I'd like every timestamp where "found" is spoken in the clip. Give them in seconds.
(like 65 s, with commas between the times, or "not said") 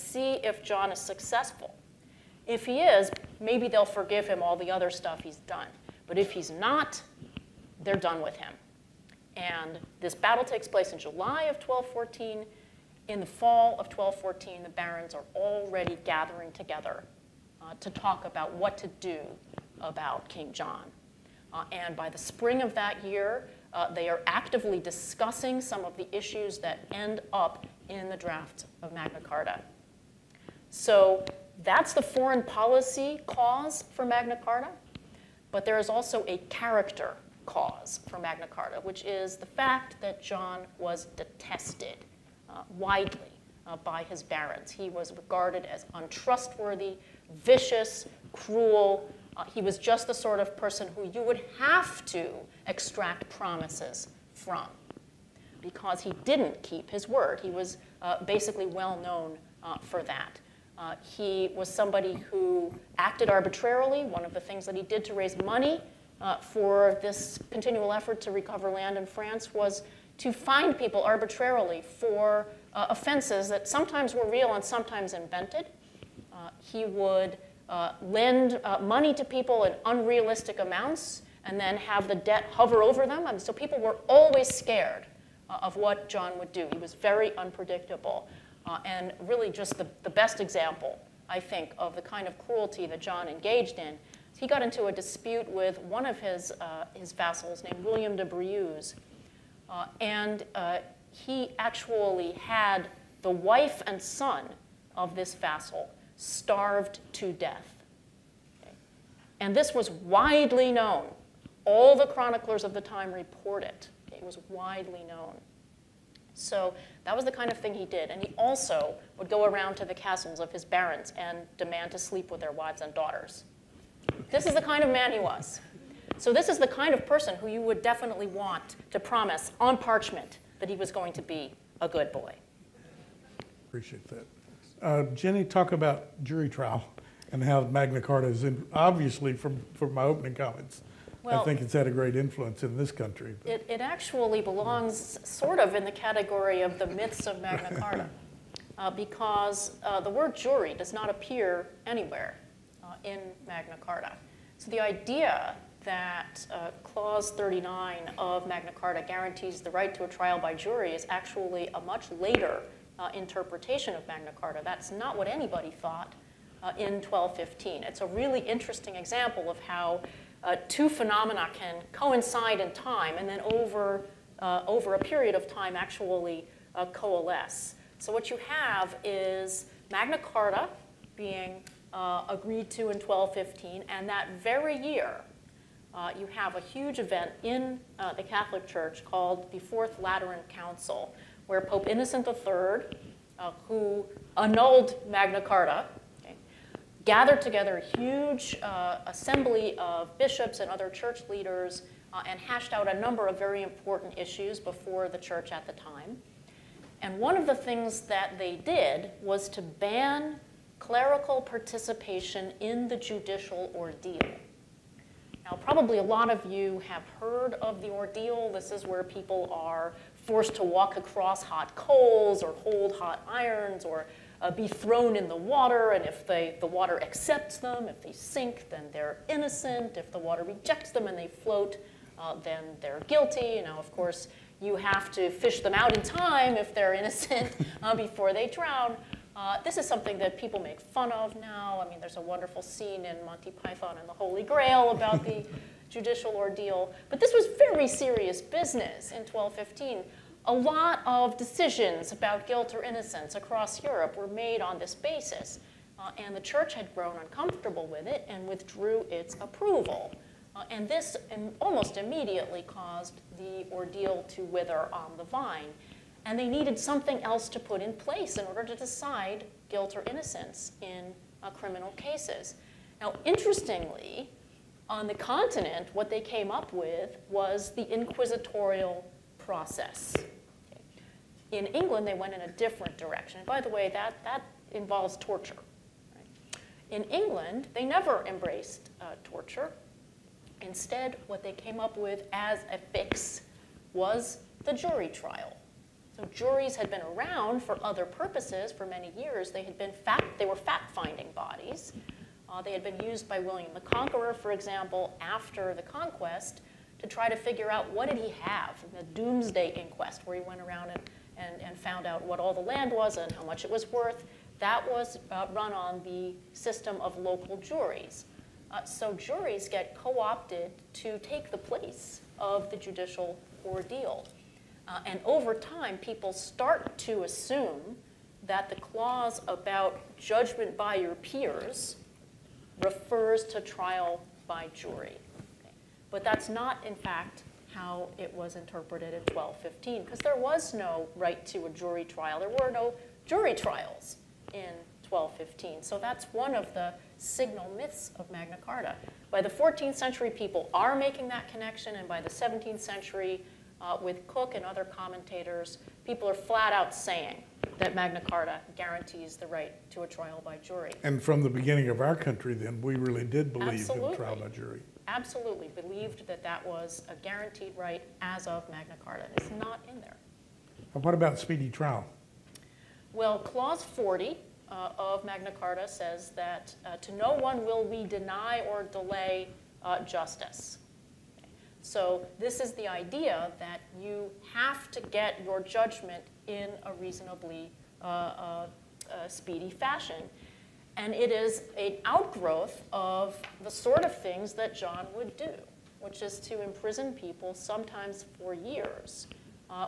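311 s.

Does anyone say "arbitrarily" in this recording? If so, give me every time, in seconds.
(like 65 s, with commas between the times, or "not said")
63 s, 71 s.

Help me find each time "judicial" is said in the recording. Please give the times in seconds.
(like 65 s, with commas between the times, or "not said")
212 s, 245 s, 322 s.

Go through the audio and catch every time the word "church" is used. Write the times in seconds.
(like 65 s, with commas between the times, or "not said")
188 s, 200 s, 205 s, 256 s.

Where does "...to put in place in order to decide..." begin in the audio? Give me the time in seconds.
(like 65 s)
267 s.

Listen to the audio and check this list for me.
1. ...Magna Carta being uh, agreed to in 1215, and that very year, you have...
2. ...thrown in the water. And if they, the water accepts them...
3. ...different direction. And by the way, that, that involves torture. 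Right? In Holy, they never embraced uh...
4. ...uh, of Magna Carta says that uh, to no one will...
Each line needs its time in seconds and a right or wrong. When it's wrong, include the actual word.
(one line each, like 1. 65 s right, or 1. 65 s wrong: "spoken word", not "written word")
1. 179 s right
2. 224 s right
3. 282 s wrong: "England", not "Holy"
4. 374 s right.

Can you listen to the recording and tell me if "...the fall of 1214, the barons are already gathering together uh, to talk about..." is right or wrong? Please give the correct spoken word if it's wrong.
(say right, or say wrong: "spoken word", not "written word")
right.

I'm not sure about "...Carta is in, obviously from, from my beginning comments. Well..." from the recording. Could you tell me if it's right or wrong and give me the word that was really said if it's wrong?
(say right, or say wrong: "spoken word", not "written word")
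wrong: "opening", not "beginning".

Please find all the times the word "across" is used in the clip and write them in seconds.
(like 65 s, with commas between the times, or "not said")
220 s, 253 s.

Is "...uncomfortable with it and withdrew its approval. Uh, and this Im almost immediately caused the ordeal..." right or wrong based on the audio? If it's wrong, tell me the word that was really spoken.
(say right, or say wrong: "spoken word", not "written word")
right.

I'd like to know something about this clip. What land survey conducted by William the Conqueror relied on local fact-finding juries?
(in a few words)
Domesday Inquest.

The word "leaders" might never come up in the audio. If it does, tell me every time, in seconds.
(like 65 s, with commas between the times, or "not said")
201 s.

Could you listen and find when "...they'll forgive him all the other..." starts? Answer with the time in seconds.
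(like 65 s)
3 s.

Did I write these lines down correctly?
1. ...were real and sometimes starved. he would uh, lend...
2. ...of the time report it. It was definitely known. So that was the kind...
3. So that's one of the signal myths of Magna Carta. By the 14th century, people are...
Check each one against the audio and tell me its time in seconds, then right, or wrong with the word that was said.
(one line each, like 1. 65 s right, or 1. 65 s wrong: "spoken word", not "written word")
1. 74 s wrong: "invented", not "starved"
2. 112 s wrong: "widely", not "definitely"
3. 345 s right.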